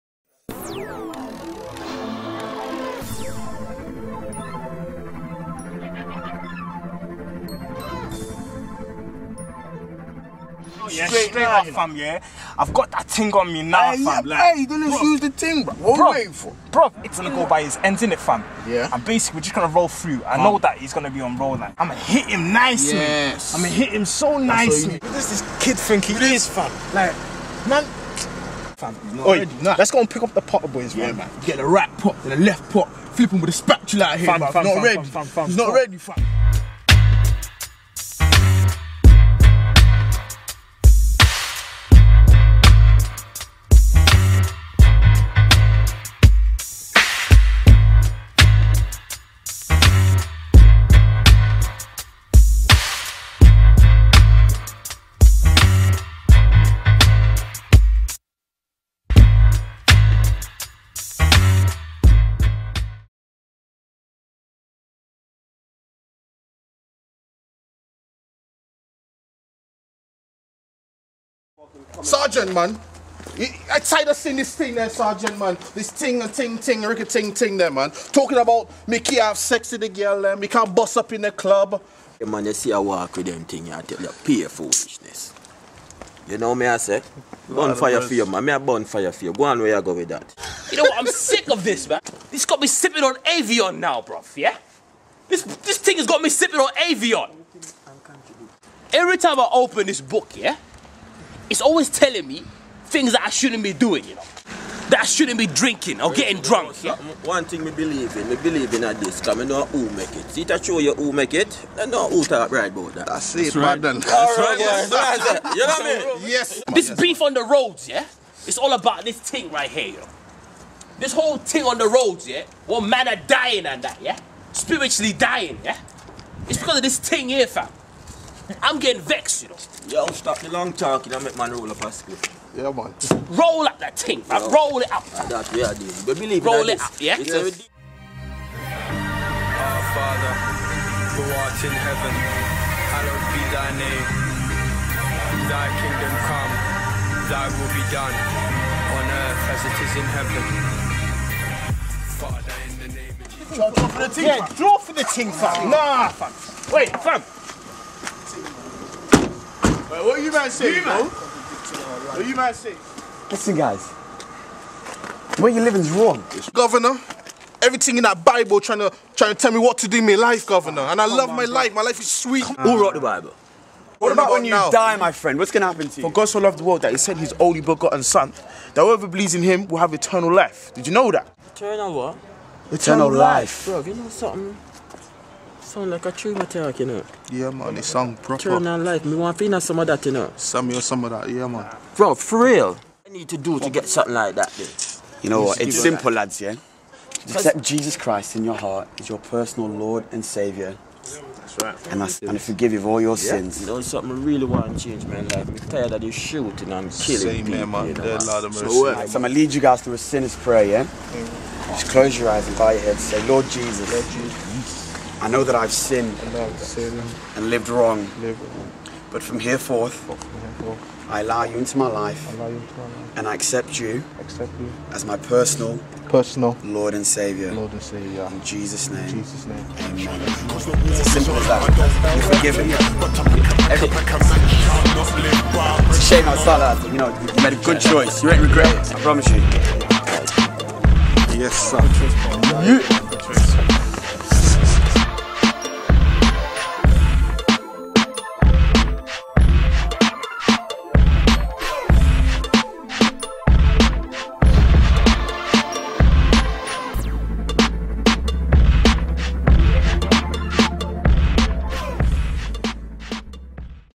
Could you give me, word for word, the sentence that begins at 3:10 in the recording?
Some of some of that, yeah, man.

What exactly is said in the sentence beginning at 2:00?
This whole thing on the roads, yeah?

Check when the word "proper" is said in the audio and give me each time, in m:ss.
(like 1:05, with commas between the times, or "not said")
3:08.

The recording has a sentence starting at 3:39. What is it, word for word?
But from here forth, I allow you into my life, and I accept you, as my personal personal Lord and Savior.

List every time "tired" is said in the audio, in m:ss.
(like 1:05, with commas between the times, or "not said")
1:13, 3:25.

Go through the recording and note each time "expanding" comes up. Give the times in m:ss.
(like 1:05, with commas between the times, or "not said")
not said.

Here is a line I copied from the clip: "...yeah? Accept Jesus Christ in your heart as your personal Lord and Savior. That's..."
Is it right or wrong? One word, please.
right.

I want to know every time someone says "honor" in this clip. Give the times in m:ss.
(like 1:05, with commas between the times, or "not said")
not said.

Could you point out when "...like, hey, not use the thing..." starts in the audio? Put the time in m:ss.
0:14.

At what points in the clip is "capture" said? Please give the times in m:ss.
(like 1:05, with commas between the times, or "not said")
not said.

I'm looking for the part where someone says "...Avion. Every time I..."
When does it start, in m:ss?
1:36.